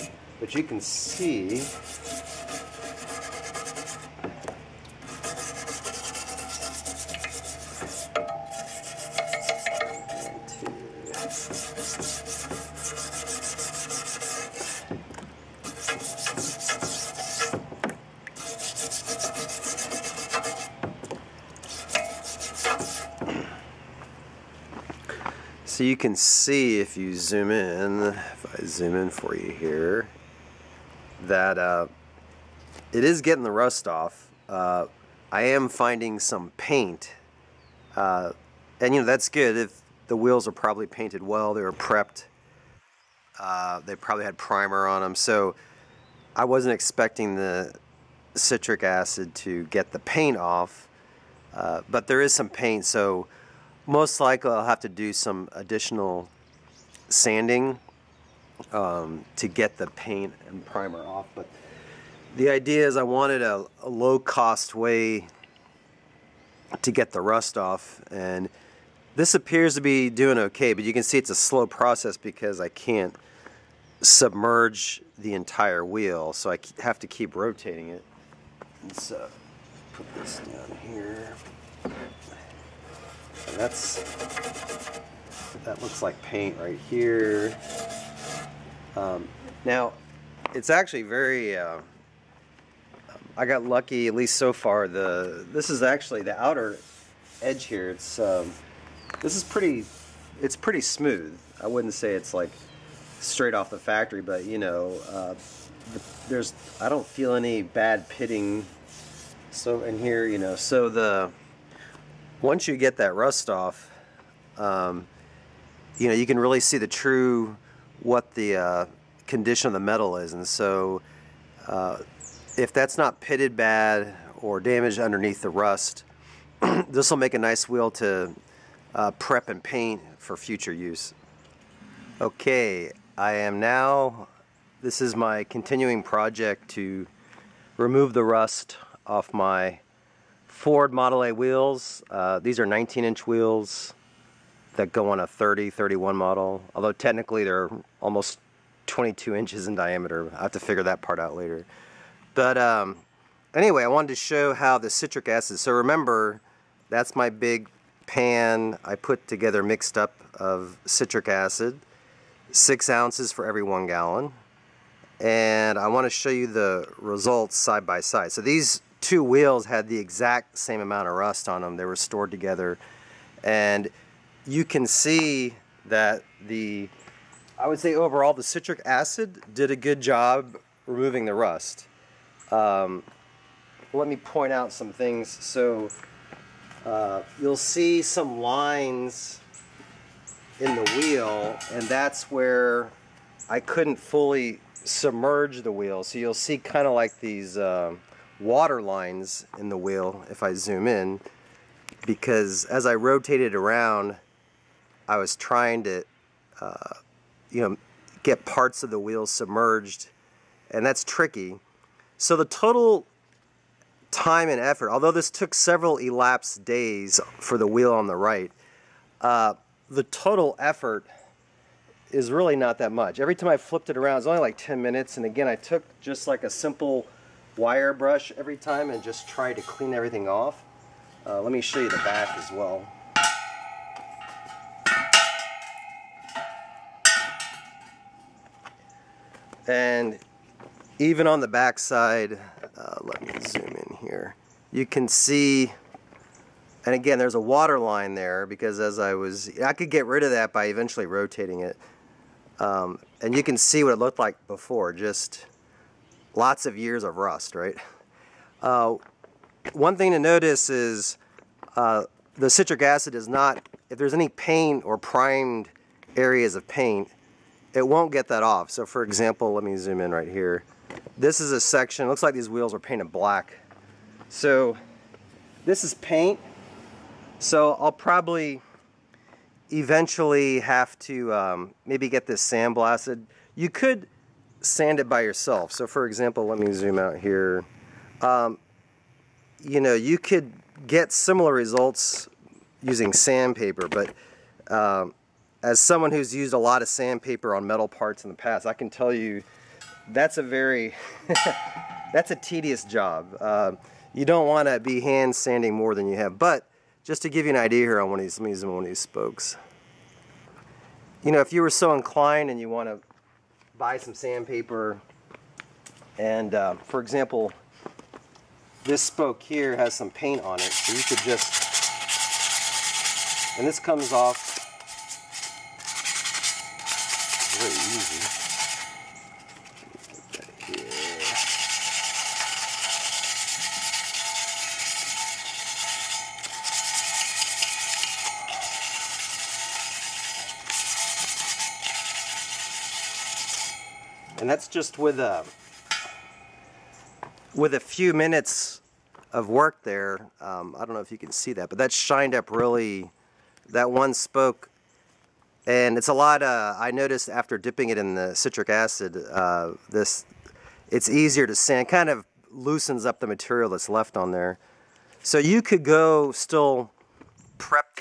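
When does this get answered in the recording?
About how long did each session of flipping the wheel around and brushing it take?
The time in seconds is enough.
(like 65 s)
224 s.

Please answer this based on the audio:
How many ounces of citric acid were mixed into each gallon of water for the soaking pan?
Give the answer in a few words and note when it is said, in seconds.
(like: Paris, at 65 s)
6 ounces, at 162 s.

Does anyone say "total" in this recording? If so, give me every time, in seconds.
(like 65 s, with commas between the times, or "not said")
212 s, 220 s.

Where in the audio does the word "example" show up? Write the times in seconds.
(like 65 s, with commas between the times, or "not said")
269 s, 286 s, 316 s.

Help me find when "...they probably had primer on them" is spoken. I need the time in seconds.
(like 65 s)
43 s.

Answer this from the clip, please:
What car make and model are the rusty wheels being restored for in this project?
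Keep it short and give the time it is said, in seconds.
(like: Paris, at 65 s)
Ford Model A, at 140 s.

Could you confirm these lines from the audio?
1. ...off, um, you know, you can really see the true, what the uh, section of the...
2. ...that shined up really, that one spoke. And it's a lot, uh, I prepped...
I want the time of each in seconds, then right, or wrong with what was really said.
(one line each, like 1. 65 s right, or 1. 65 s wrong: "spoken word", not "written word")
1. 113 s wrong: "condition", not "section"
2. 351 s wrong: "noticed", not "prepped".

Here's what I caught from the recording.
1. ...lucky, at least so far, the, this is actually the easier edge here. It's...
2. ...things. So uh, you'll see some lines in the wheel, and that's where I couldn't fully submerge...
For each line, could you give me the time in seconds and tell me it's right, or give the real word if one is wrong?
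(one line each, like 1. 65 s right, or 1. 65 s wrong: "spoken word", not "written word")
1. 93 s wrong: "outer", not "easier"
2. 184 s right.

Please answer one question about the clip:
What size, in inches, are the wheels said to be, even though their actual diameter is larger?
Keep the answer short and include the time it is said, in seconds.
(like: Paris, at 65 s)
19 inches, at 142 s.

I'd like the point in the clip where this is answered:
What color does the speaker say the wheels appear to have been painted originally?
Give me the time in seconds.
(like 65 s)
273 s.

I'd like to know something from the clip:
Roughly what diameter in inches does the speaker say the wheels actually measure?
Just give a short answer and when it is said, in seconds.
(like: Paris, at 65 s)
22 inches, at 147 s.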